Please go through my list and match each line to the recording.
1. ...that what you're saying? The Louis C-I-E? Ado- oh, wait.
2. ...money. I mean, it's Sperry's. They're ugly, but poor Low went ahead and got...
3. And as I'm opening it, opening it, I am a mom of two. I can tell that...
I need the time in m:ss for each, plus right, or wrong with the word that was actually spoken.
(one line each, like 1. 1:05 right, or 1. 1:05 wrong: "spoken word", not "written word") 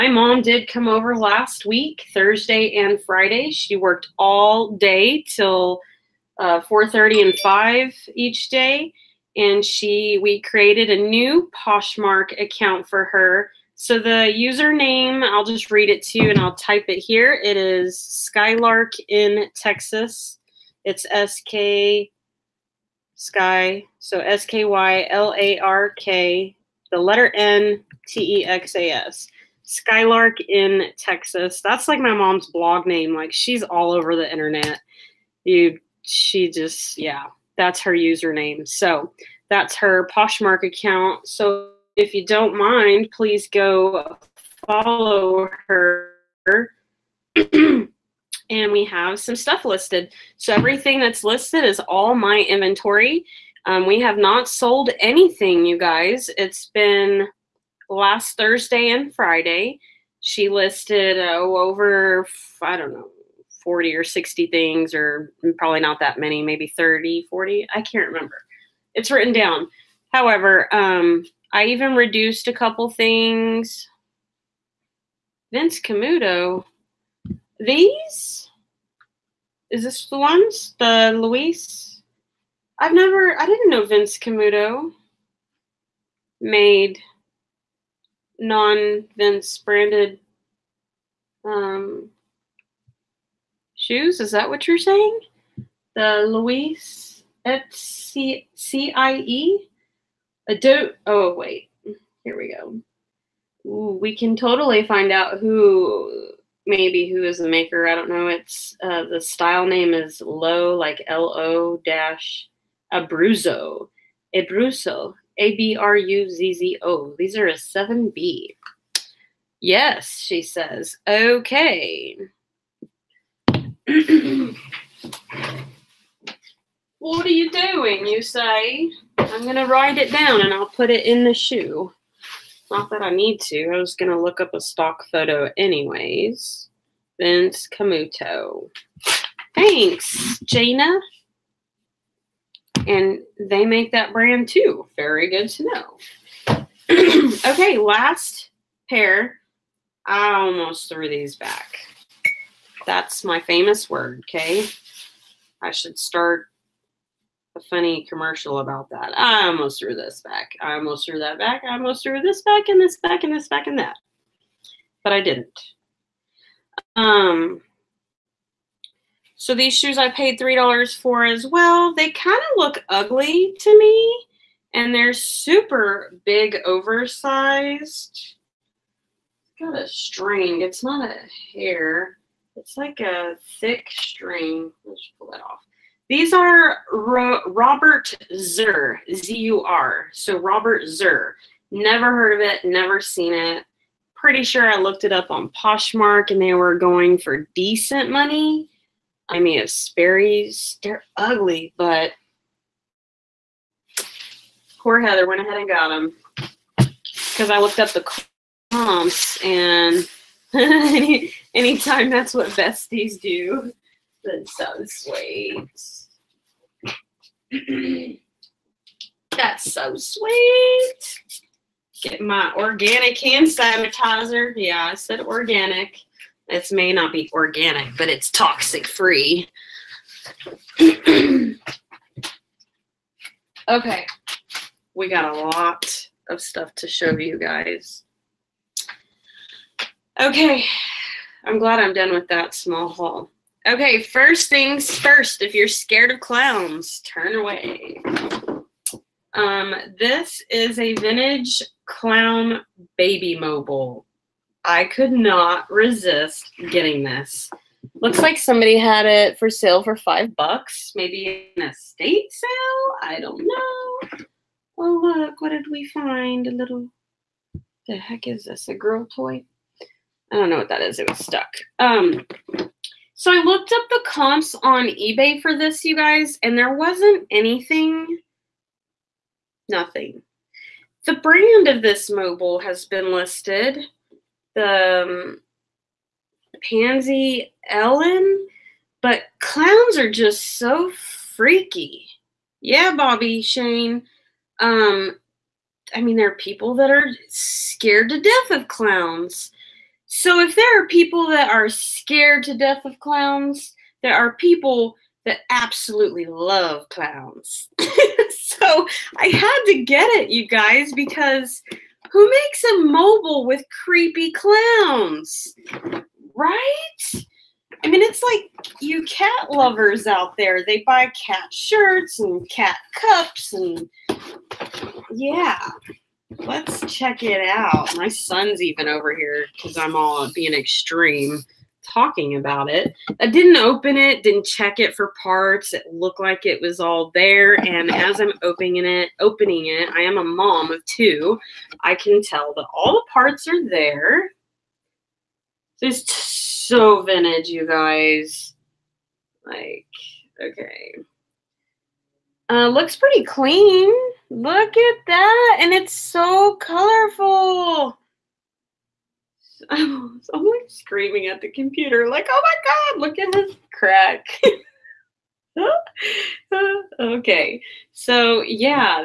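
1. 1:34 right
2. 3:18 wrong: "Heather", not "Low"
3. 5:37 right.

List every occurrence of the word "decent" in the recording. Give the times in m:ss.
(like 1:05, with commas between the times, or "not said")
3:17.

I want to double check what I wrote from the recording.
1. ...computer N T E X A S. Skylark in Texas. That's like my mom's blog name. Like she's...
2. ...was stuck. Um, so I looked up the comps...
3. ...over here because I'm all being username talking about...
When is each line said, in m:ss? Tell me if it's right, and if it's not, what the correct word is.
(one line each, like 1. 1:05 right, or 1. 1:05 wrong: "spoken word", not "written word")
1. 0:26 wrong: "letter", not "computer"
2. 4:31 right
3. 5:28 wrong: "extreme", not "username".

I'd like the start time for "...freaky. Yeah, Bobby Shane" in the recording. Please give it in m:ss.
4:50.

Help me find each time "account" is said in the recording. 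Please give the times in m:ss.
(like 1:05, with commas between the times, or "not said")
0:12, 0:40.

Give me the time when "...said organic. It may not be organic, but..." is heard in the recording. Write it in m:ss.
3:44.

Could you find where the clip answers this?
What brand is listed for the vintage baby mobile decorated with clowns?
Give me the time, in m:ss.
4:46.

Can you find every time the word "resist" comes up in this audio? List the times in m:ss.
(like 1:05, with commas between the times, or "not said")
4:15.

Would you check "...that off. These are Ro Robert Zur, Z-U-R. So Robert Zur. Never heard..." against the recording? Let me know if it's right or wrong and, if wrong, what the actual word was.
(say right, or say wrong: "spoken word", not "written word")
right.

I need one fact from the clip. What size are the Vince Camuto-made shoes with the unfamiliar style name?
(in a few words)
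7B.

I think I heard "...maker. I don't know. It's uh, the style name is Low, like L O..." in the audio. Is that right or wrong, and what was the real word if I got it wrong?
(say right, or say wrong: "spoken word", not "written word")
right.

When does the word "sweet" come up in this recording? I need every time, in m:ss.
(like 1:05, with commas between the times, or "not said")
3:34, 3:39.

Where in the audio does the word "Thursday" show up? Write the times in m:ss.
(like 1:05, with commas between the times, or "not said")
0:02, 0:58.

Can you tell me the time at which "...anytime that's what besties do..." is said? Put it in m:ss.
3:31.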